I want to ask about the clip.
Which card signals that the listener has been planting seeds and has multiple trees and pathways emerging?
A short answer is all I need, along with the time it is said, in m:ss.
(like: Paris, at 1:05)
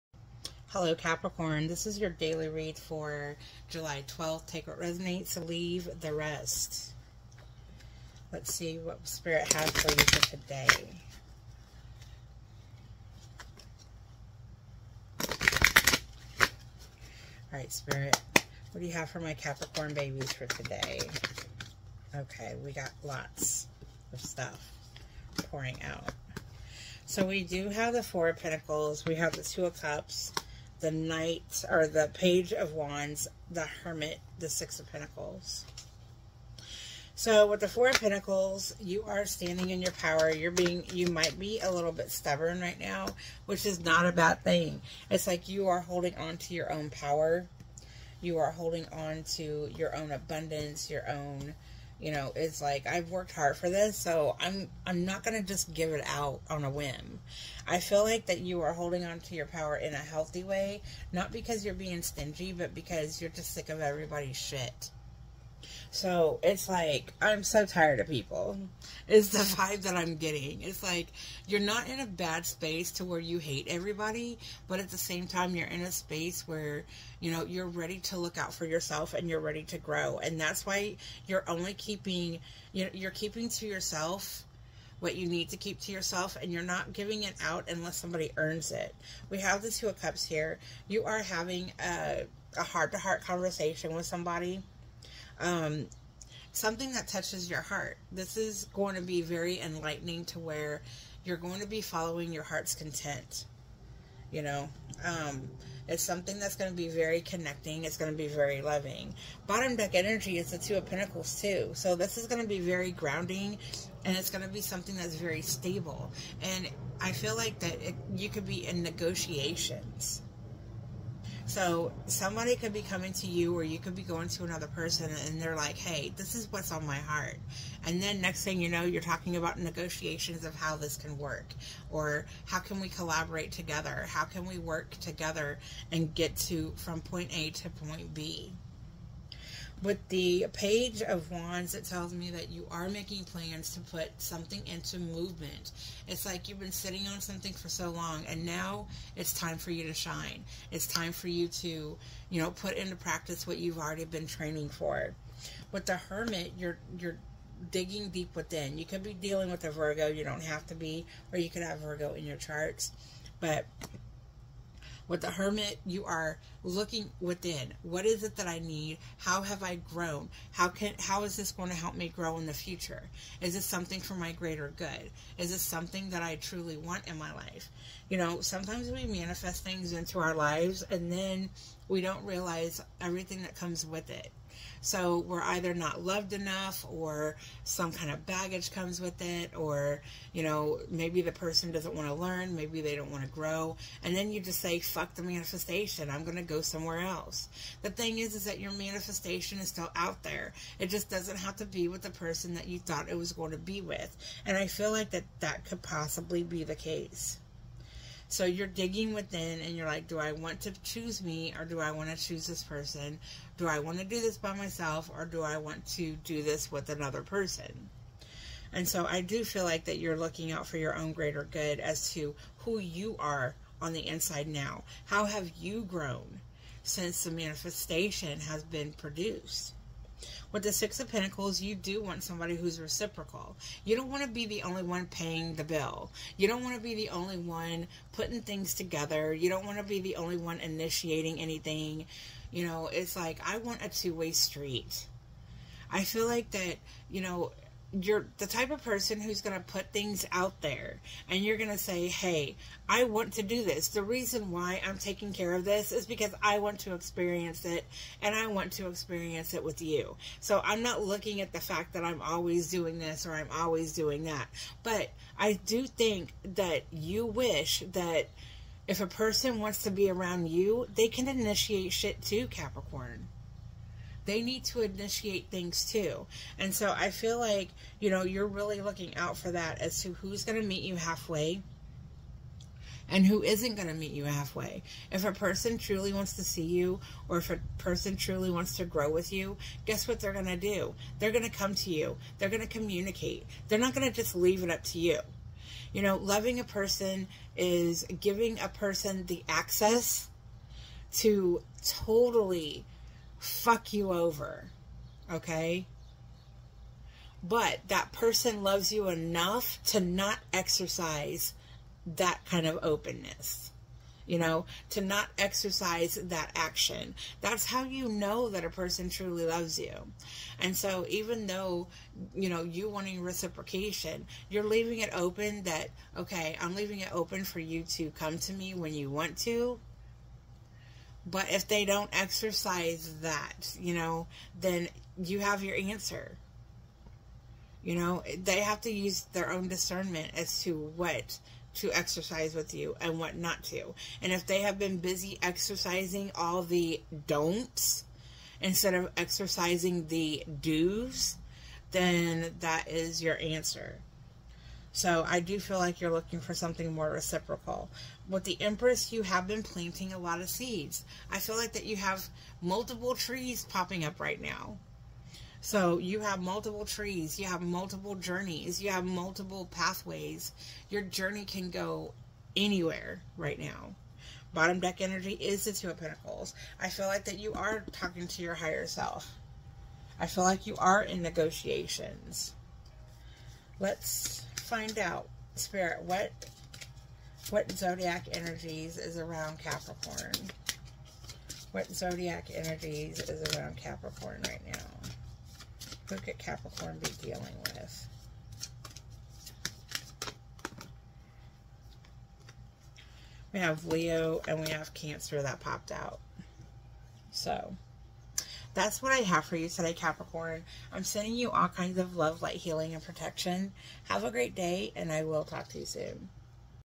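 The Empress, at 5:58.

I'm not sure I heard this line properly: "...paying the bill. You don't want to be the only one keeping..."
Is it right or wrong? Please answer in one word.
wrong.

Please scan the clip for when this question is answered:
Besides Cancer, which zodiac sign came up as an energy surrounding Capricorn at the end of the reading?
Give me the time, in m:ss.
6:43.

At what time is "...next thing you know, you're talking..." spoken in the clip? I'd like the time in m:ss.
2:08.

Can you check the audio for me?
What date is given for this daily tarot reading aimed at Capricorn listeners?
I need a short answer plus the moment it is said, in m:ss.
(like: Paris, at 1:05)
July 12th, at 0:03.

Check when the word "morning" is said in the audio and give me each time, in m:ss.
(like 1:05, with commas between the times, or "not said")
not said.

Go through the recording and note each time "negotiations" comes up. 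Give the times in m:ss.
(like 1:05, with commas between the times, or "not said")
1:58, 2:09, 6:21.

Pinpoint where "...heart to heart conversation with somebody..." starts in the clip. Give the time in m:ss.
1:32.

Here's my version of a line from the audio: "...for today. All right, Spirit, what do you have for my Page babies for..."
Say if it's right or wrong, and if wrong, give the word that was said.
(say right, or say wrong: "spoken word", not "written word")
wrong: "Capricorn", not "Page".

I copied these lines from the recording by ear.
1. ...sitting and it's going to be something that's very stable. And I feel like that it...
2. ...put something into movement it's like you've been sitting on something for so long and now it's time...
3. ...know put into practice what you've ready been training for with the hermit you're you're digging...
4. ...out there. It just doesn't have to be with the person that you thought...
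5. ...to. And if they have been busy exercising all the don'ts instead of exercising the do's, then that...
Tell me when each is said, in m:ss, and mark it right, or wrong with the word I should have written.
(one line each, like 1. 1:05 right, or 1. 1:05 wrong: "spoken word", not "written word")
1. 1:52 wrong: "grounding", not "sitting"
2. 2:23 right
3. 2:32 wrong: "already", not "ready"
4. 3:19 right
5. 5:43 right.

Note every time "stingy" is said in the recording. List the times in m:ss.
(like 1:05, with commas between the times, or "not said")
1:02.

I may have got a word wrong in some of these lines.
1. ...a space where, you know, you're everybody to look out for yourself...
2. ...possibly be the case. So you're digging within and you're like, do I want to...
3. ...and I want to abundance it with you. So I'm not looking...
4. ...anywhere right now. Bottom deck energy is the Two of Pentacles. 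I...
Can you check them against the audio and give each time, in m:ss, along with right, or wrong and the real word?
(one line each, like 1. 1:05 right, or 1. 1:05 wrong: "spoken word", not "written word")
1. 1:15 wrong: "ready", not "everybody"
2. 3:25 right
3. 4:18 wrong: "experience", not "abundance"
4. 6:12 right.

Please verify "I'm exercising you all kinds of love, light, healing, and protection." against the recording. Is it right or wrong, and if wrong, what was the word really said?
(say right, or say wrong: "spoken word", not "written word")
wrong: "sending", not "exercising".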